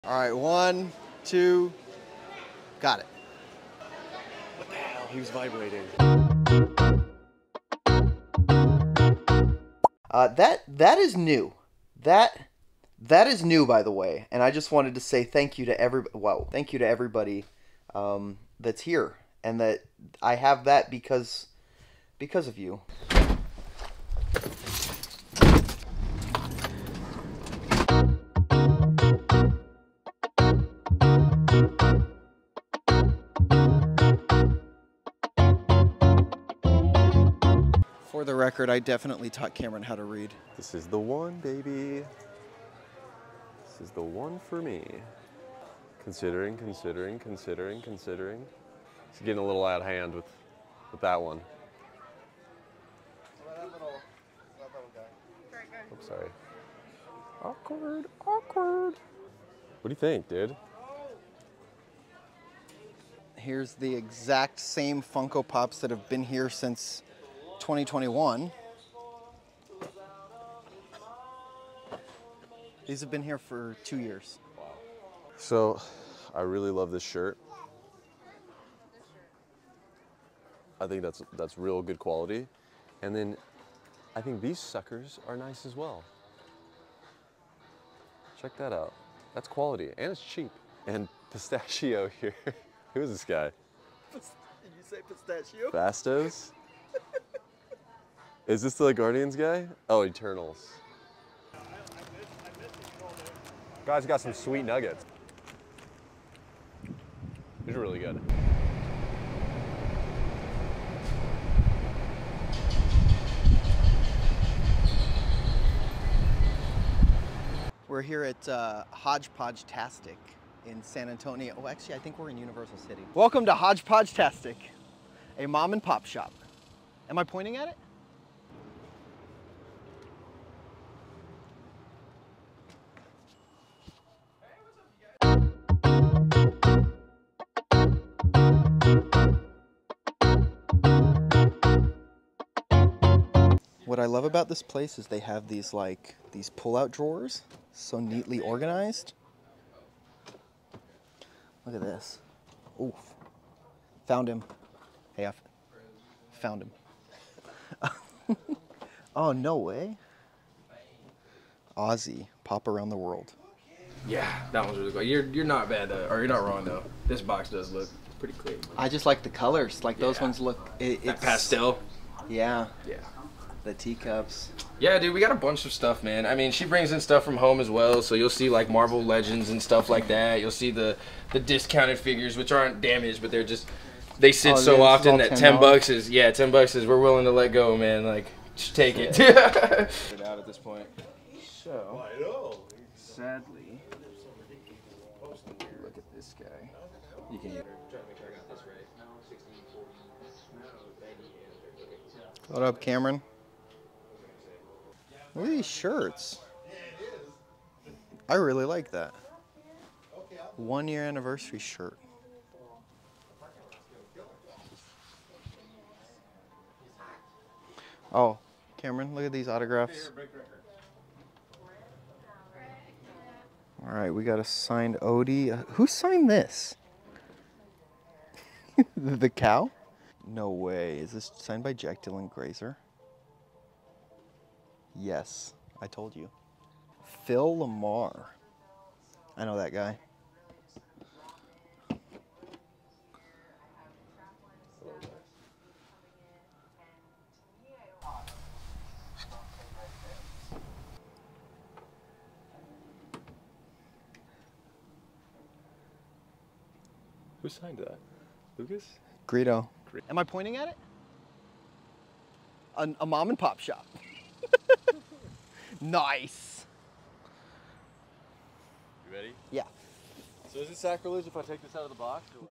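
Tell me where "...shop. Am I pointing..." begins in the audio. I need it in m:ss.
2:06.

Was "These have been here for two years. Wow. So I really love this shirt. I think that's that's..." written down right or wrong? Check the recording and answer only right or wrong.
right.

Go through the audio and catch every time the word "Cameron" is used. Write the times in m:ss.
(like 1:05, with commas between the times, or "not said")
0:39, 3:22, 3:38.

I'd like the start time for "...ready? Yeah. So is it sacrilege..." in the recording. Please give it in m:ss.
4:29.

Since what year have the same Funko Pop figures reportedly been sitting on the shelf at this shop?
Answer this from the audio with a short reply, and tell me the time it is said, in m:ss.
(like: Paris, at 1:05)
2021, at 1:07.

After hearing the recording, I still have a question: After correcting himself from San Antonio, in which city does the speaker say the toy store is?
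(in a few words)
Universal City.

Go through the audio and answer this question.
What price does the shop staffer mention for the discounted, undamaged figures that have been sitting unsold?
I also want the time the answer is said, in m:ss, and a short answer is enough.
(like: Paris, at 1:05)
$10, at 3:06.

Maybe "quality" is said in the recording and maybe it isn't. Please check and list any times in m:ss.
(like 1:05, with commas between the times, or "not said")
1:21, 1:29.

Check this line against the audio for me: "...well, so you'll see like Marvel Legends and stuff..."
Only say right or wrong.
right.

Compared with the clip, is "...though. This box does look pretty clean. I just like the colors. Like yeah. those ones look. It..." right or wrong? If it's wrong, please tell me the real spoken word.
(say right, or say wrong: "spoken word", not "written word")
right.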